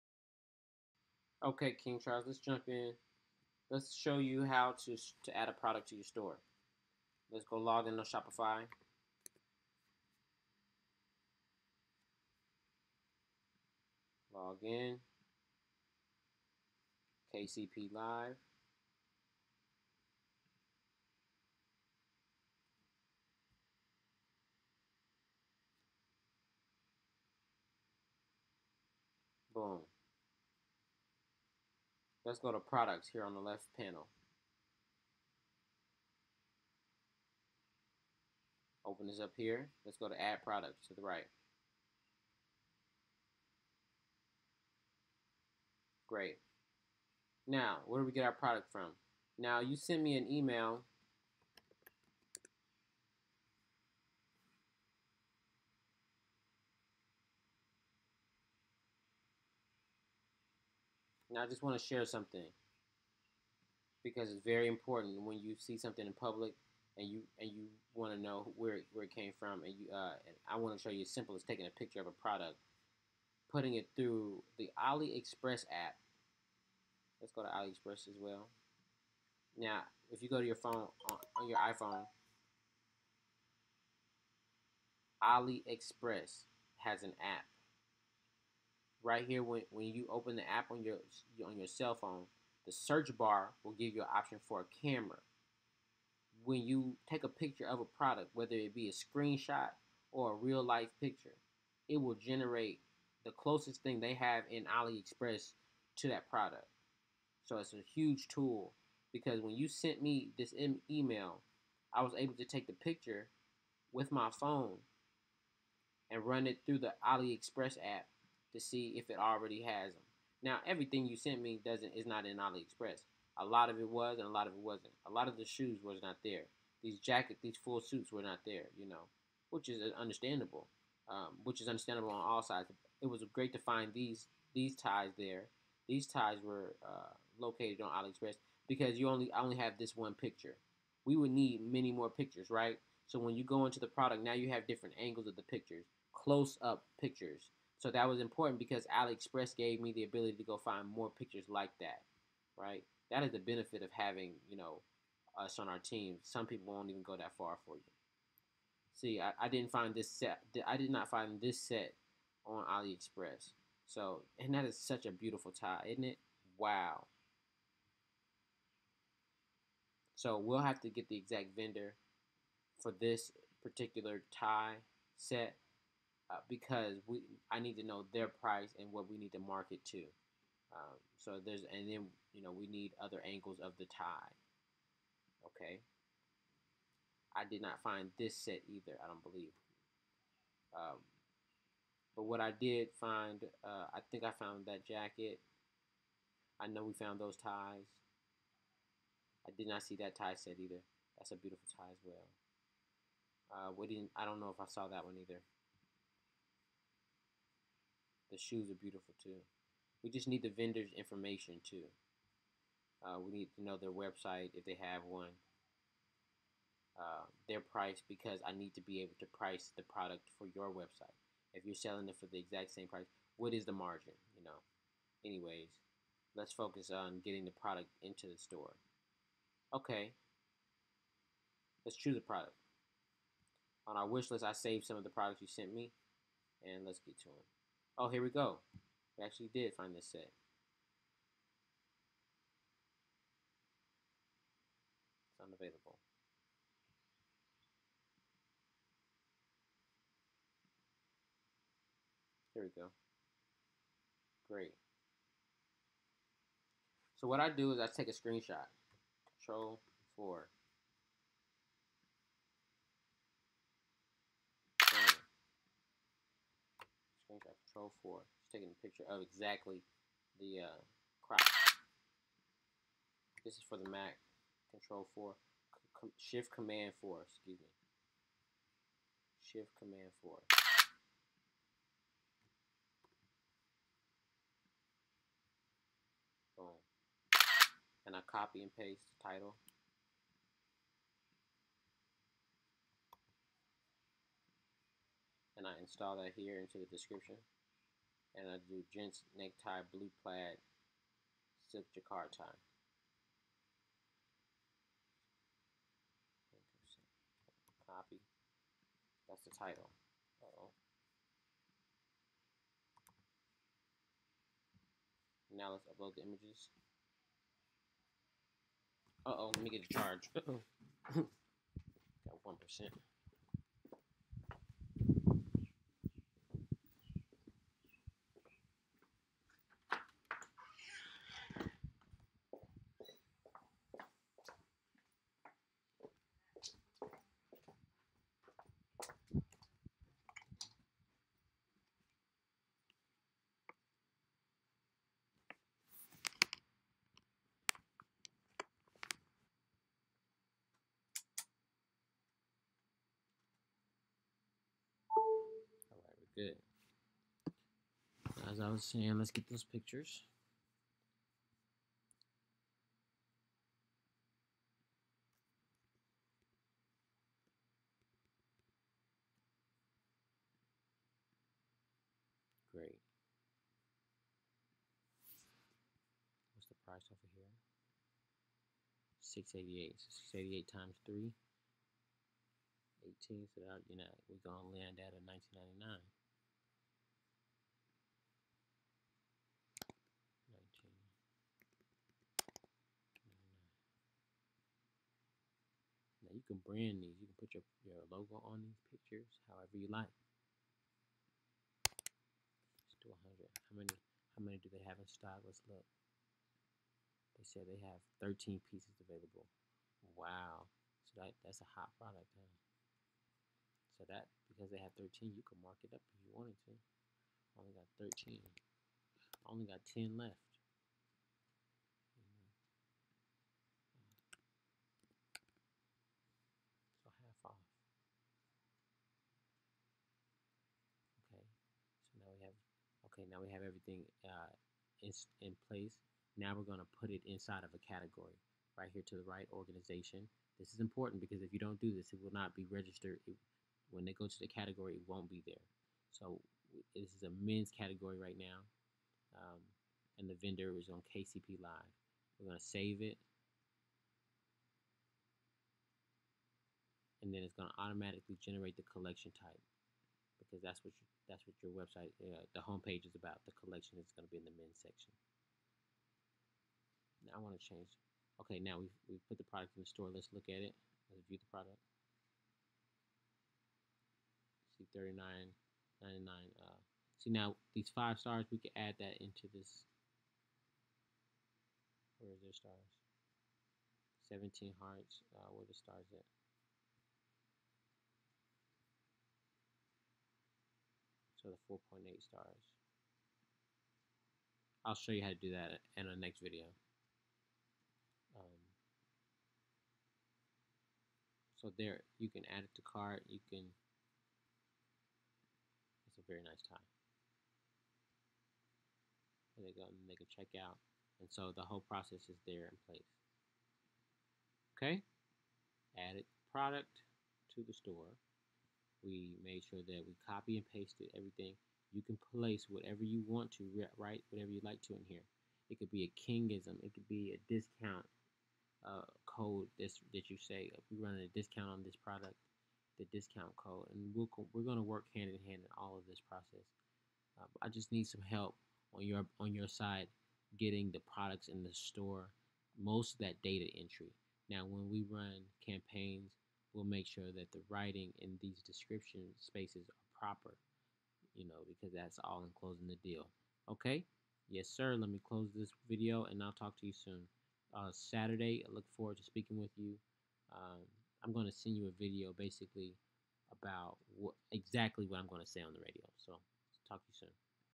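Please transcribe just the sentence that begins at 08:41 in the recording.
You can place whatever you want to, write whatever you like to in here.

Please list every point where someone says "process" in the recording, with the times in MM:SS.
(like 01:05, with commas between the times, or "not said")
08:31, 08:56.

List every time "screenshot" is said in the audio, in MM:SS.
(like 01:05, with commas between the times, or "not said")
01:39, 04:18.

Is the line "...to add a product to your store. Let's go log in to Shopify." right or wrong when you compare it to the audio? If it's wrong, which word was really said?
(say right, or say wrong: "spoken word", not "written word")
right.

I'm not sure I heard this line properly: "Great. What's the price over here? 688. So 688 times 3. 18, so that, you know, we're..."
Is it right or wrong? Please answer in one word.
right.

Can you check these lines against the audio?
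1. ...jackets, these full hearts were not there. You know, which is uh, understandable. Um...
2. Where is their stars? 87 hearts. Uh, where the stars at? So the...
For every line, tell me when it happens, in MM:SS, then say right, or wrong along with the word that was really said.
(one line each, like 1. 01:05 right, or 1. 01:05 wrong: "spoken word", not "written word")
1. 02:06 wrong: "suits", not "hearts"
2. 08:02 wrong: "17", not "87".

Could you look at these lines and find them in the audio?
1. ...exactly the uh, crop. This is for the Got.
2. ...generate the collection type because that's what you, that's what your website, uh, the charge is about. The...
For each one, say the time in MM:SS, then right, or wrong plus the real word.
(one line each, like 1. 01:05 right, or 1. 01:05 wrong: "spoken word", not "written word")
1. 04:29 wrong: "Mac", not "Got"
2. 07:38 wrong: "homepage", not "charge".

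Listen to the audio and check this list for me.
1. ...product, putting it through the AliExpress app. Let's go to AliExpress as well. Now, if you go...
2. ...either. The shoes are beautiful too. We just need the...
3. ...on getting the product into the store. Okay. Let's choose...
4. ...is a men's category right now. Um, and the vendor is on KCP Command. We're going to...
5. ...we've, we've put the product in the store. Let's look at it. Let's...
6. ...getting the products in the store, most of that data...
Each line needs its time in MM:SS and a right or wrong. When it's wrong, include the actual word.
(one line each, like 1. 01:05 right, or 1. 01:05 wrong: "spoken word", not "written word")
1. 01:12 right
2. 03:25 right
3. 03:46 right
4. 07:27 wrong: "Live", not "Command"
5. 07:48 right
6. 09:00 right.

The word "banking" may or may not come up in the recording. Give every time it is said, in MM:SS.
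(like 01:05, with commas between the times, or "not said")
not said.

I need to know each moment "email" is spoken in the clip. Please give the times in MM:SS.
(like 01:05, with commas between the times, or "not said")
00:50, 01:50.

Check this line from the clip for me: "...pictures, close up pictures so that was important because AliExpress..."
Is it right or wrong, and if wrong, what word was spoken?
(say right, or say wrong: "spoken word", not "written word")
right.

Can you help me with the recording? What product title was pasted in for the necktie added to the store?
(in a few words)
Gents necktie blue plaid silk jacquard tie.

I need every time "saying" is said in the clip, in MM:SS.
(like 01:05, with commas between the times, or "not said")
05:58.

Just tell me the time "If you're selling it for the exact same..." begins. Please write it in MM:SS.
03:41.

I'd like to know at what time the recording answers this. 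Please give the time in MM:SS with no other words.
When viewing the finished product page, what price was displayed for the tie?
07:54.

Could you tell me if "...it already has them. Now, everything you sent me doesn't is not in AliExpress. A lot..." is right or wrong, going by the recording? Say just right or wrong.
right.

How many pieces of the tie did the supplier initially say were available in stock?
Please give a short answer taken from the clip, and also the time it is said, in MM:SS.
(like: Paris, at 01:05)
13, at 06:48.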